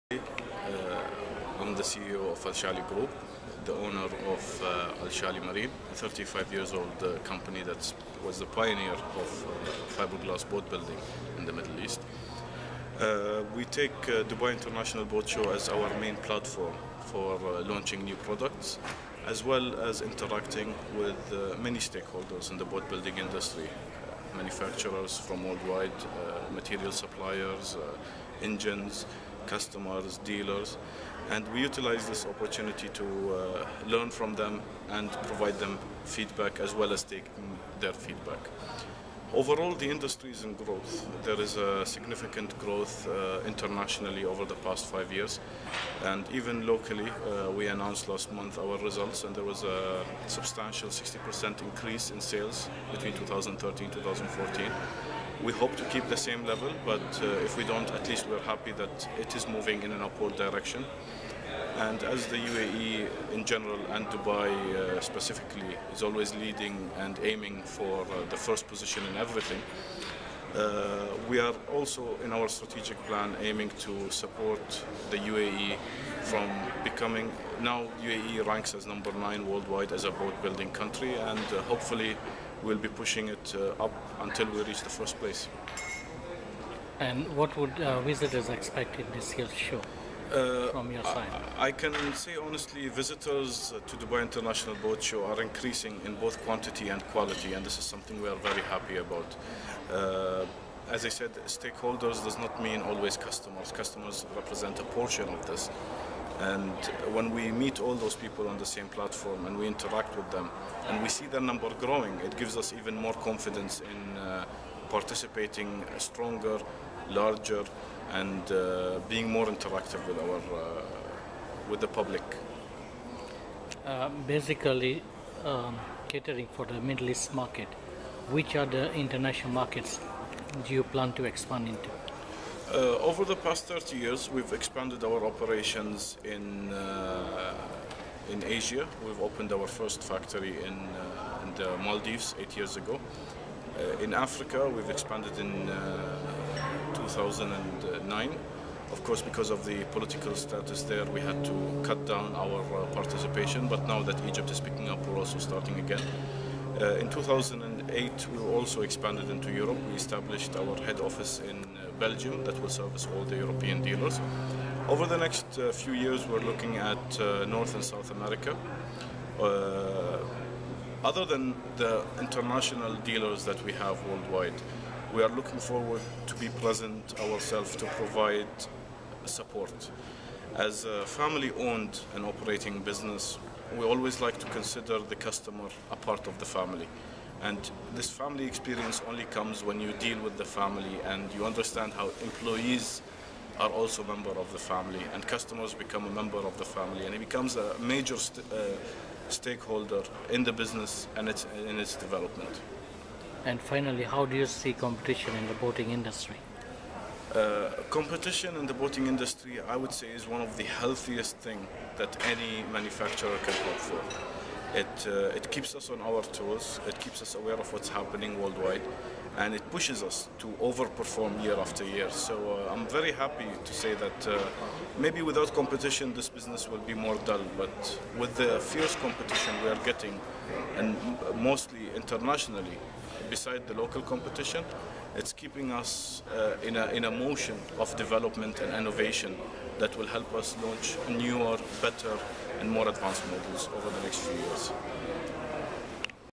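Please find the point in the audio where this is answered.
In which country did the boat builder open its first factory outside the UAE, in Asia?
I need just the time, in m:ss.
2:21.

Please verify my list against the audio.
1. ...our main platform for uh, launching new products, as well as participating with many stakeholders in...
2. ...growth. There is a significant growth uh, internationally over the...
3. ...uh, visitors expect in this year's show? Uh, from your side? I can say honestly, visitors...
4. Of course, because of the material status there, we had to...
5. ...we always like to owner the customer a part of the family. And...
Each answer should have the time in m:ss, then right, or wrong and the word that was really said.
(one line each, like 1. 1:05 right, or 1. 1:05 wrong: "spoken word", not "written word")
1. 0:15 wrong: "interacting", not "participating"
2. 0:40 right
3. 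1:27 right
4. 2:28 wrong: "political", not "material"
5. 3:03 wrong: "consider", not "owner".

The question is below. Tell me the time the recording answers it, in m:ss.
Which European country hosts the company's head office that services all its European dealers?
2:41.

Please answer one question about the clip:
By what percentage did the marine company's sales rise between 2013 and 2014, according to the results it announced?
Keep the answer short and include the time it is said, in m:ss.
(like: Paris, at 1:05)
60%, at 0:50.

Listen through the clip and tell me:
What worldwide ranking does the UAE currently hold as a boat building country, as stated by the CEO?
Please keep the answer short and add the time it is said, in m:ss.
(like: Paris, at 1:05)
9, at 1:18.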